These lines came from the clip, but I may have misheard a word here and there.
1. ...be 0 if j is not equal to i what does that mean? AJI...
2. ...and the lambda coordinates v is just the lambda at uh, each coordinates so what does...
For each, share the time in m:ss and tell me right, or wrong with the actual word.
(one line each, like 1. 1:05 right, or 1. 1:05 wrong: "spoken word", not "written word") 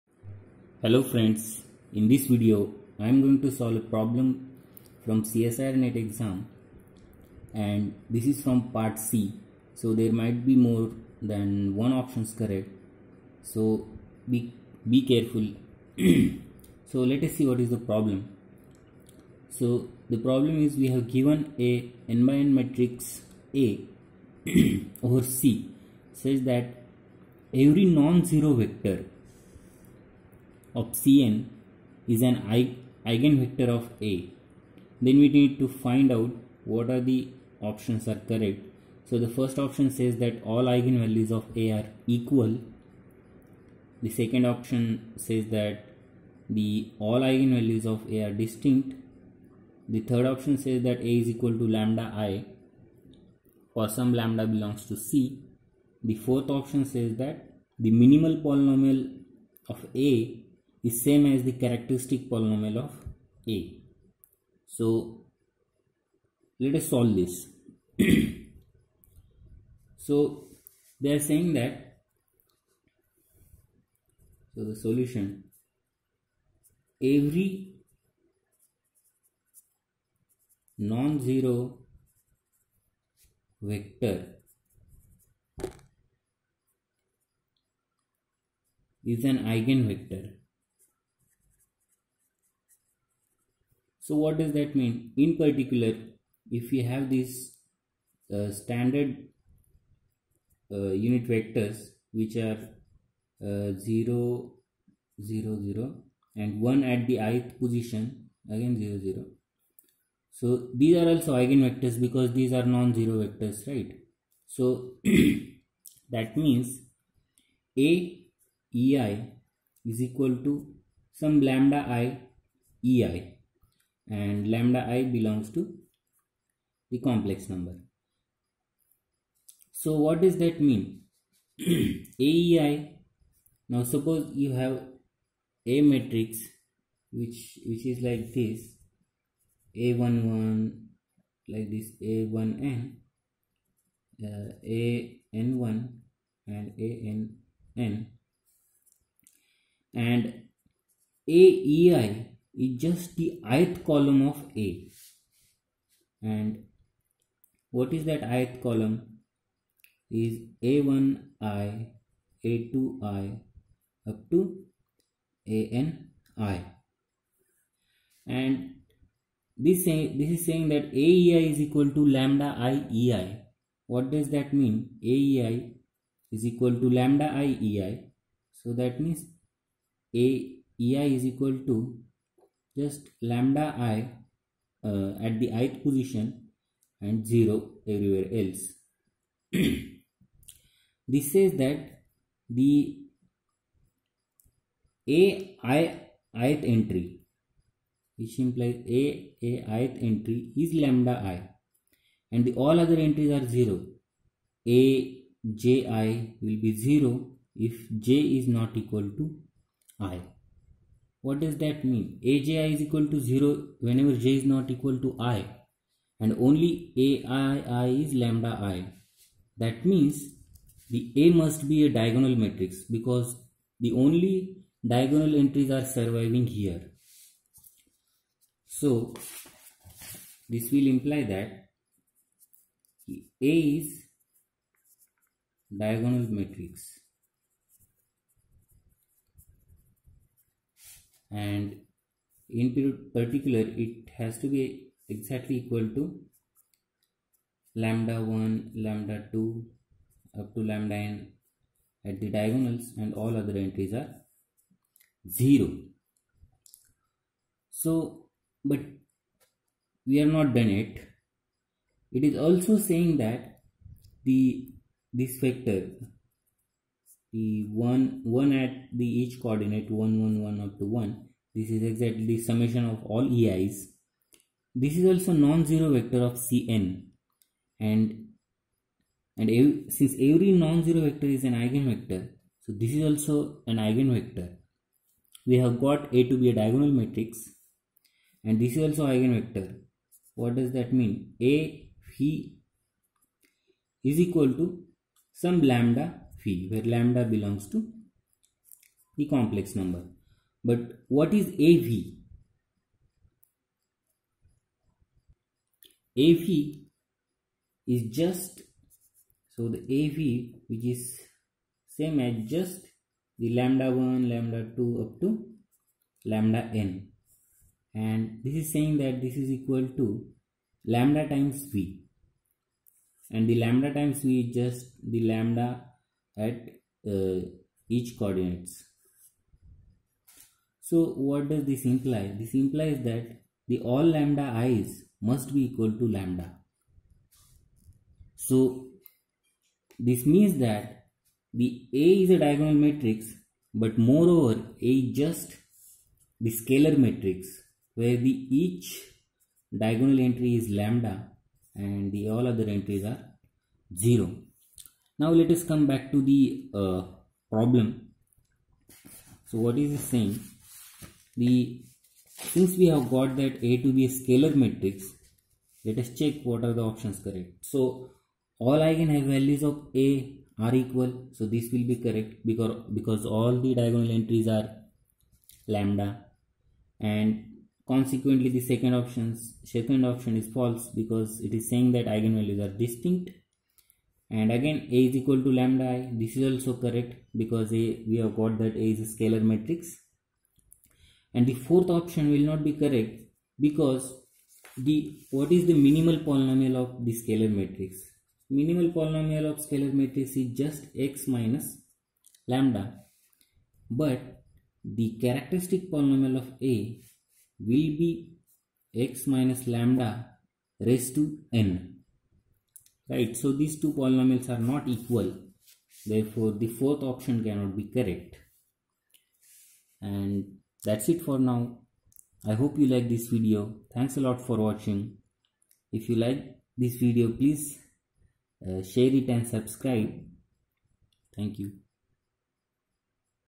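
1. 3:26 right
2. 5:23 wrong: "times", not "coordinates".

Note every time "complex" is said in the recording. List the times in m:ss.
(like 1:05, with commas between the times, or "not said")
2:07, 4:59.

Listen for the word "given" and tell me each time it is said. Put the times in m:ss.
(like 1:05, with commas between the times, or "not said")
0:21.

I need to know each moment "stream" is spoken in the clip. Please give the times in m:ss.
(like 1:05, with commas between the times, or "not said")
not said.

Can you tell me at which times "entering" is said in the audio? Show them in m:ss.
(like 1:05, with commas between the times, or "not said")
not said.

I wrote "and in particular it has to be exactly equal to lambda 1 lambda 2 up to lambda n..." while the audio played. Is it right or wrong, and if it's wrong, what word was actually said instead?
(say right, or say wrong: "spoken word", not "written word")
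right.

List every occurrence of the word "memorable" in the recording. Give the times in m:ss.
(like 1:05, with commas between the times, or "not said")
not said.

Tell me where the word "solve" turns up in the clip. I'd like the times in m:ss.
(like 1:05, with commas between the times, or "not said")
0:03, 1:06.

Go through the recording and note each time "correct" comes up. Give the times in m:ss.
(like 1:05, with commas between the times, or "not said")
0:12, 0:38, 6:07, 6:12, 6:26, 6:32, 6:57.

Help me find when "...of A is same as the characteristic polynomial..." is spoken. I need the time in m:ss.
0:59.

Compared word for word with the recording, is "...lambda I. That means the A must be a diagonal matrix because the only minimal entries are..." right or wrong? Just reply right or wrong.
wrong.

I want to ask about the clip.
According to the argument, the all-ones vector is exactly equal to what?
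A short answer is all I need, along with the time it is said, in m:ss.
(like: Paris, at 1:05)
Summation of all ei's, at 4:32.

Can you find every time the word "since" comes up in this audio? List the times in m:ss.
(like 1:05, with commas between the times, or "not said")
4:39, 6:02.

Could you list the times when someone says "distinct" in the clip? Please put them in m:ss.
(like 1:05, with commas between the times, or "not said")
0:48, 6:22.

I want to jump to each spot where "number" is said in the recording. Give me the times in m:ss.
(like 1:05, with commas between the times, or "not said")
2:07, 4:59.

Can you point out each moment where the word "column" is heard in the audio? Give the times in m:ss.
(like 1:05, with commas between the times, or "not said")
2:33, 2:38.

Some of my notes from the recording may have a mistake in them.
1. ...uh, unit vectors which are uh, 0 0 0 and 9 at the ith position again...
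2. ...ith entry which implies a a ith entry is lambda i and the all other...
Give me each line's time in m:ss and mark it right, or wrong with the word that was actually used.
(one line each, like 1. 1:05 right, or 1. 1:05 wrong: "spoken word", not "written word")
1. 1:40 wrong: "1", not "9"
2. 3:16 right.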